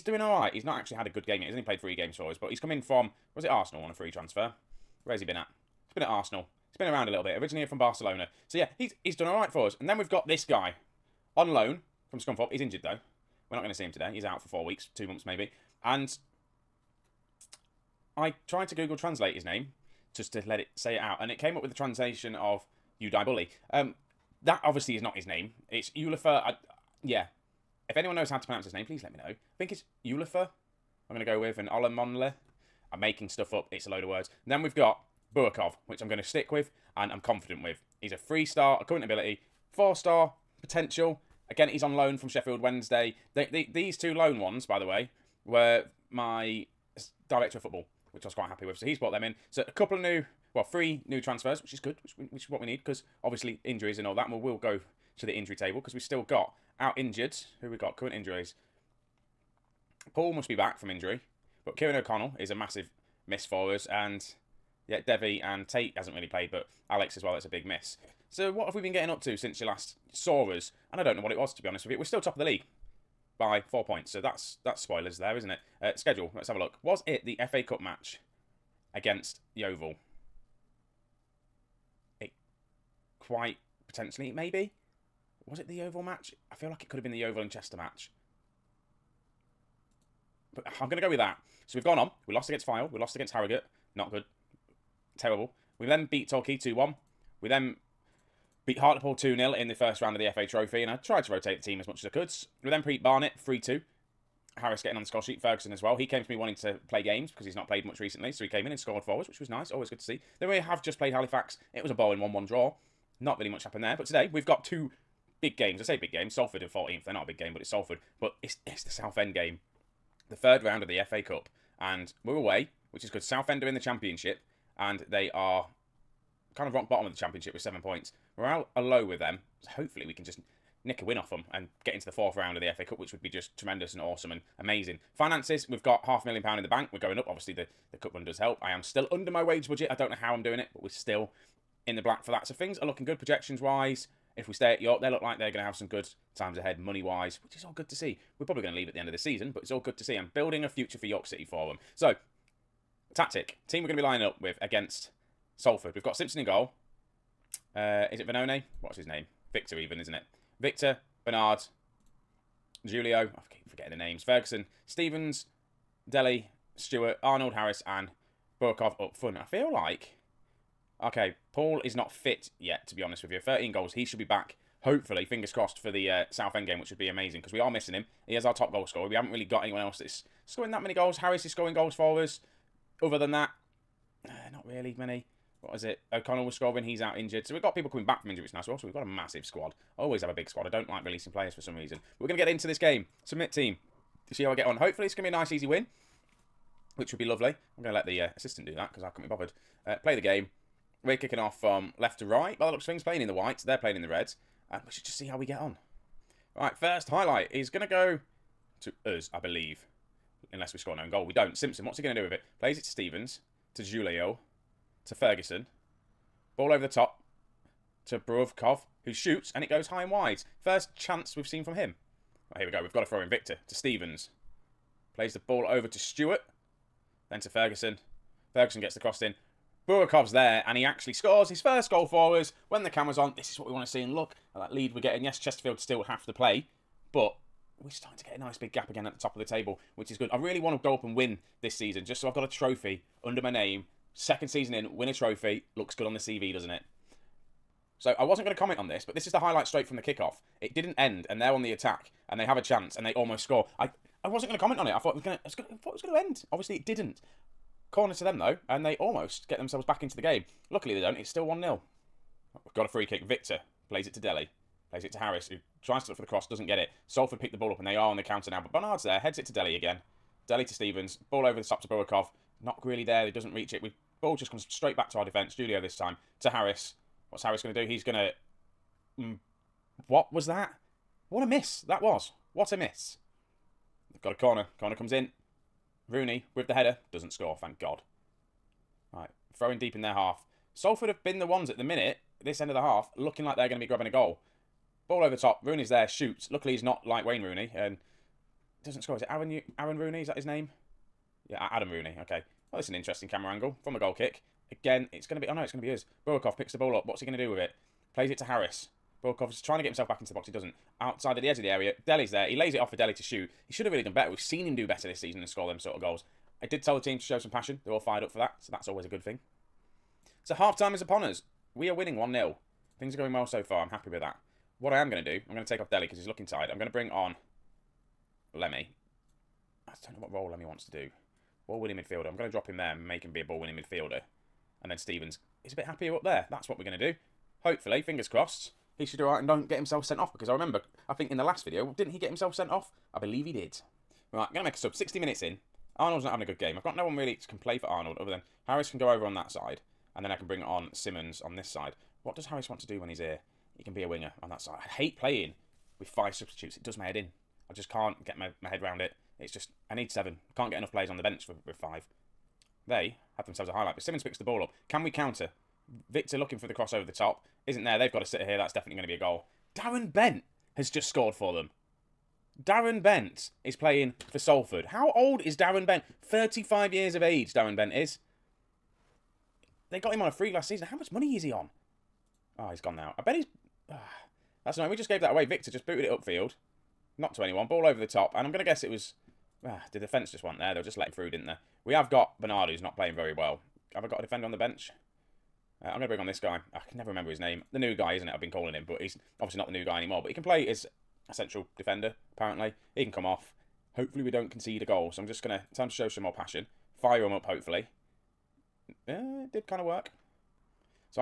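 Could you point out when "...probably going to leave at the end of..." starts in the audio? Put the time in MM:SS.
02:28.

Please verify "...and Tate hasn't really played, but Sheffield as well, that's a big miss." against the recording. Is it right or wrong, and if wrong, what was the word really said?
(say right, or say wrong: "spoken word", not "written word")
wrong: "Alex", not "Sheffield".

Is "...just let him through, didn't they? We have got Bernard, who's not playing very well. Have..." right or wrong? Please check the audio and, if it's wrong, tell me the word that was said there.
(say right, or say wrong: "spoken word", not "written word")
right.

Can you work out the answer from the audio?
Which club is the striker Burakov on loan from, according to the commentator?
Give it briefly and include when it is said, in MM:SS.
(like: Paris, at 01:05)
Sheffield Wednesday, at 00:42.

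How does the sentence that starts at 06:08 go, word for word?
That's definitely going to be a goal.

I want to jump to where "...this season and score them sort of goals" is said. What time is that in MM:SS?
05:15.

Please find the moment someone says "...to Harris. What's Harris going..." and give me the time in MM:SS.
04:36.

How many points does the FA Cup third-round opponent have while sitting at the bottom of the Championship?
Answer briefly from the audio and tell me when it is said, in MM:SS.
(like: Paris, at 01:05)
7, at 02:07.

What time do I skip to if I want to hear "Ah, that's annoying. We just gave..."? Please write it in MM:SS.
06:23.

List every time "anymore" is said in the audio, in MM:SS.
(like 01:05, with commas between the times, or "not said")
06:39.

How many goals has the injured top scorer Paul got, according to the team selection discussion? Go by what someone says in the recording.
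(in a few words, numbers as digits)
13.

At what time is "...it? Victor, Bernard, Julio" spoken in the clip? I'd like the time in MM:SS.
02:40.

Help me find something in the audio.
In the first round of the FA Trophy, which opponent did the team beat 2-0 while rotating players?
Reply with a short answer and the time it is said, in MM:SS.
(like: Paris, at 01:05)
Hartlepool, at 01:38.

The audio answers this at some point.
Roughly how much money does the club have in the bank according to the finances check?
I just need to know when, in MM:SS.
02:16.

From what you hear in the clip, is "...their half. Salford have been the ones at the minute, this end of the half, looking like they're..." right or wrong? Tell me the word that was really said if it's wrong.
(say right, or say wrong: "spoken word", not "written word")
right.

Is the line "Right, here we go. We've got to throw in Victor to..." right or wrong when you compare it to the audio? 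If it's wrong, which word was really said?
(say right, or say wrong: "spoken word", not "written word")
right.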